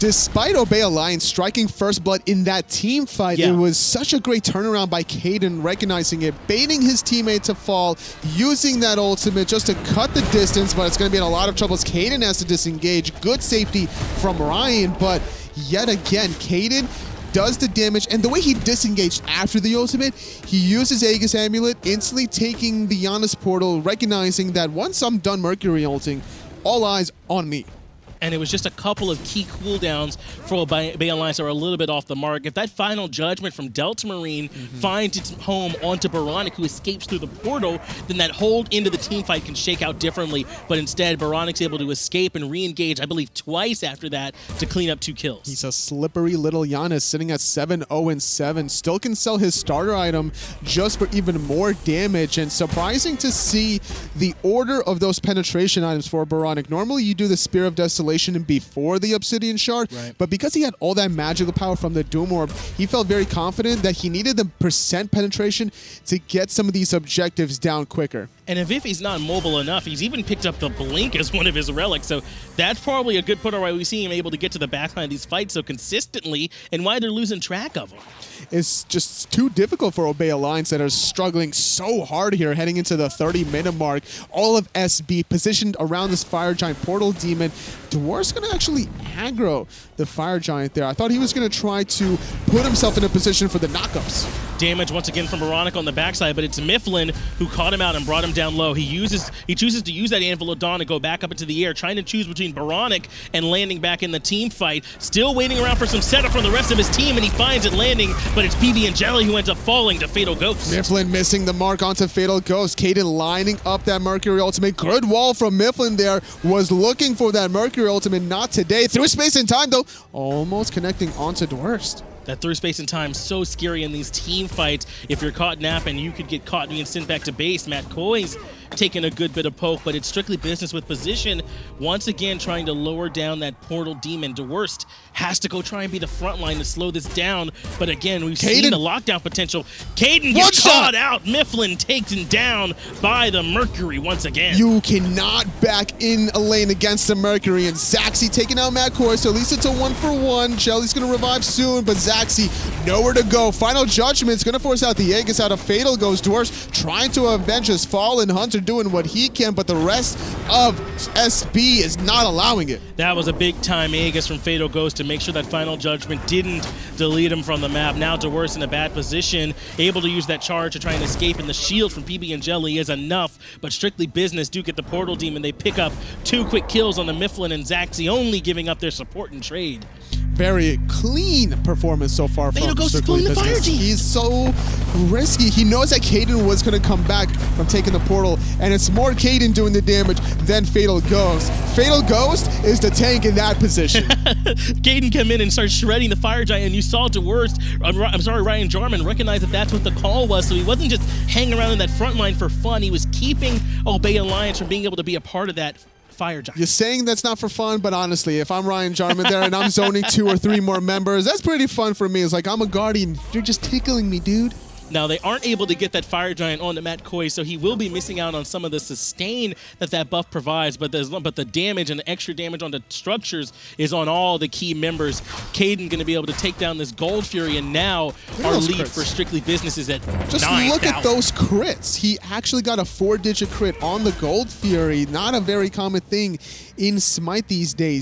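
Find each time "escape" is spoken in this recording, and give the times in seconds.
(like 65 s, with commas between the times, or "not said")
36 s, 41 s, 171 s.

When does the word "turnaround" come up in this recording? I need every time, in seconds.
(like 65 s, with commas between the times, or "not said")
4 s.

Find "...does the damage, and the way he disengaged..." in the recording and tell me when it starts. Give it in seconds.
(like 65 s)
17 s.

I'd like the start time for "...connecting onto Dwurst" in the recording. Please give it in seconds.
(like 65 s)
120 s.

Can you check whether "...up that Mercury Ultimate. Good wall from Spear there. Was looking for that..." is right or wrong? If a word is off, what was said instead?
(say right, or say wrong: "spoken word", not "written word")
wrong: "Myflin", not "Spear".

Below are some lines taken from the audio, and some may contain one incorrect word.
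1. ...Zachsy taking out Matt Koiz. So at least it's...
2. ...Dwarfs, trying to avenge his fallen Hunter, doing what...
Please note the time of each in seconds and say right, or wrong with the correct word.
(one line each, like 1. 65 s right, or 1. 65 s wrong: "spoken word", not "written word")
1. 147 s right
2. 156 s right.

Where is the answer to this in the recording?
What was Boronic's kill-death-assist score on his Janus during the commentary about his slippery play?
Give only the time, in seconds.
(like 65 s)
47 s.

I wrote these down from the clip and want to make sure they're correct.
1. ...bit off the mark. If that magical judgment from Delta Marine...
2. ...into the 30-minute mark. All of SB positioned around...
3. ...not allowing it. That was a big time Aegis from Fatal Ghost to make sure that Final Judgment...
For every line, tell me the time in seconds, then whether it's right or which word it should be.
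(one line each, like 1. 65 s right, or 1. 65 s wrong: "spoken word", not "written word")
1. 31 s wrong: "final", not "magical"
2. 82 s right
3. 161 s right.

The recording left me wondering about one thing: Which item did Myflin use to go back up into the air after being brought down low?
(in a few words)
Anvil of Dawn.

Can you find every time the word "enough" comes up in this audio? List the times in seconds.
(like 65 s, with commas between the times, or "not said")
69 s, 172 s.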